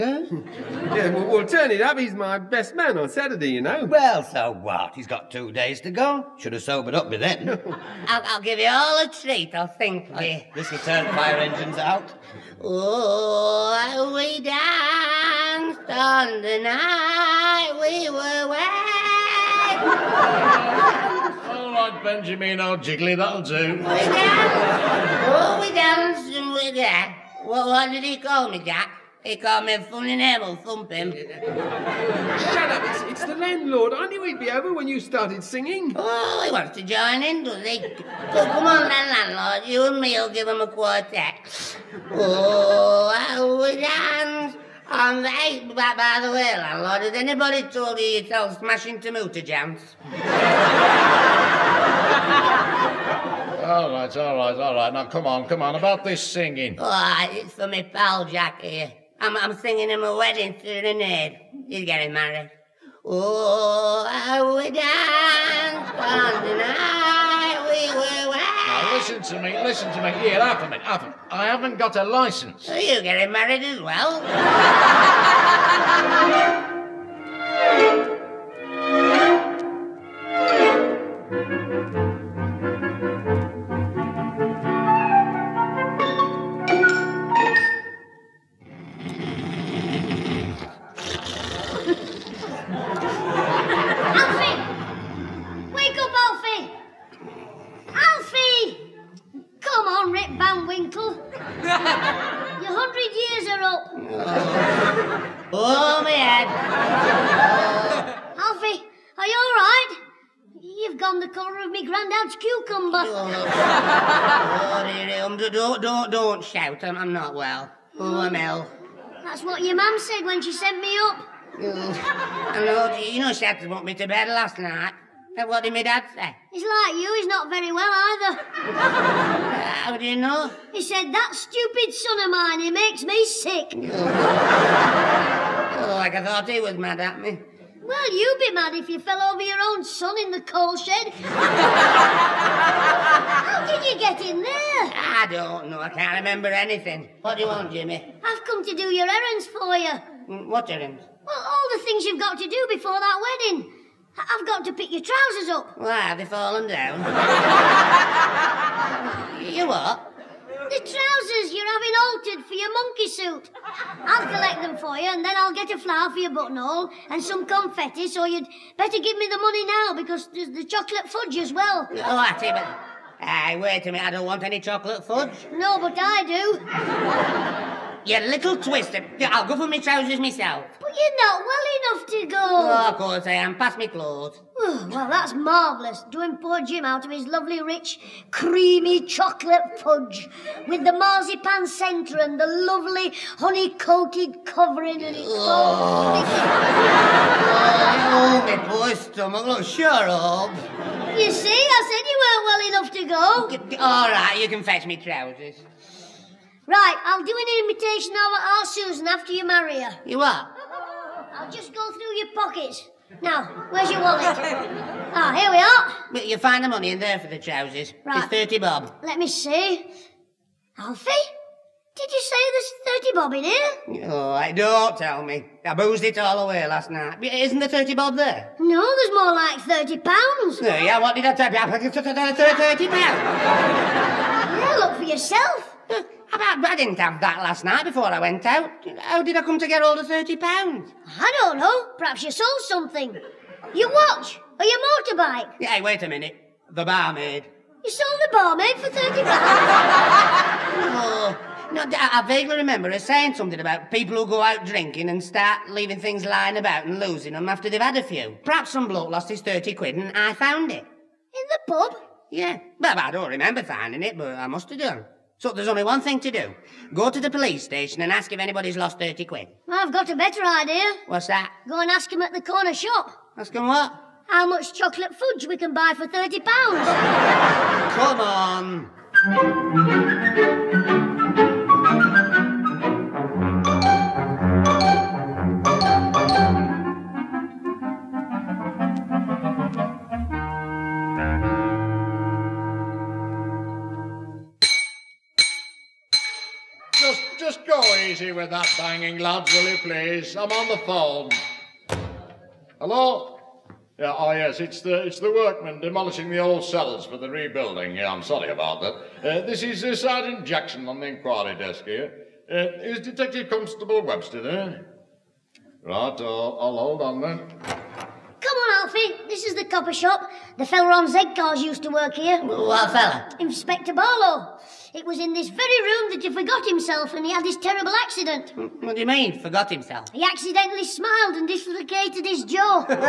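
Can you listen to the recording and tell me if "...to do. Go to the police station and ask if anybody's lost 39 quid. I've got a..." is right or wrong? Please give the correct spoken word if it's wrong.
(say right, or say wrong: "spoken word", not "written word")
wrong: "30", not "39".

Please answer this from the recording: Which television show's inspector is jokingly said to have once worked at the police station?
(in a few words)
Z Cars.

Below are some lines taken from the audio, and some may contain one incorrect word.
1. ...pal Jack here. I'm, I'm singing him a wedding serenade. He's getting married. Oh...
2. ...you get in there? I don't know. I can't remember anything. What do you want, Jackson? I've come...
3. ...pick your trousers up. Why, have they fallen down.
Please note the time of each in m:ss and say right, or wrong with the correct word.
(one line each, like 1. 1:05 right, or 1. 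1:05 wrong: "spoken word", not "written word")
1. 0:57 right
2. 2:23 wrong: "Jimmy", not "Jackson"
3. 2:34 right.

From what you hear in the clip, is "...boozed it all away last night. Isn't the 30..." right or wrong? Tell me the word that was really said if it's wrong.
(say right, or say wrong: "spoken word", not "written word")
right.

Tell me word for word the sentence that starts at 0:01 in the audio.
He's my best man on Saturday, you know.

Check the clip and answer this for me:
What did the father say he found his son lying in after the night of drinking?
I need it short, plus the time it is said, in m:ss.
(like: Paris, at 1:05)
the coal shed, at 2:20.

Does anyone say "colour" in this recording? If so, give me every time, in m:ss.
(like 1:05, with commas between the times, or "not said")
1:51.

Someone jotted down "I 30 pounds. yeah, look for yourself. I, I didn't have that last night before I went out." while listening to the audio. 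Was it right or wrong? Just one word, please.
right.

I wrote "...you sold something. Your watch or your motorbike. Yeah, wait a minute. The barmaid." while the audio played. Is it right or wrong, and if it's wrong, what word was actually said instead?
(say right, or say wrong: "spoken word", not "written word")
right.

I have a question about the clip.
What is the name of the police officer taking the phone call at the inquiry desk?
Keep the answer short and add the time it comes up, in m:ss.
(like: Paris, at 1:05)
Sergeant Jackson, at 5:09.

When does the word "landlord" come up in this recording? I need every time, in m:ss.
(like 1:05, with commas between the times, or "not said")
0:33, 0:39, 0:46.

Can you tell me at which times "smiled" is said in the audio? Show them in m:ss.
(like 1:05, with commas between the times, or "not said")
5:30.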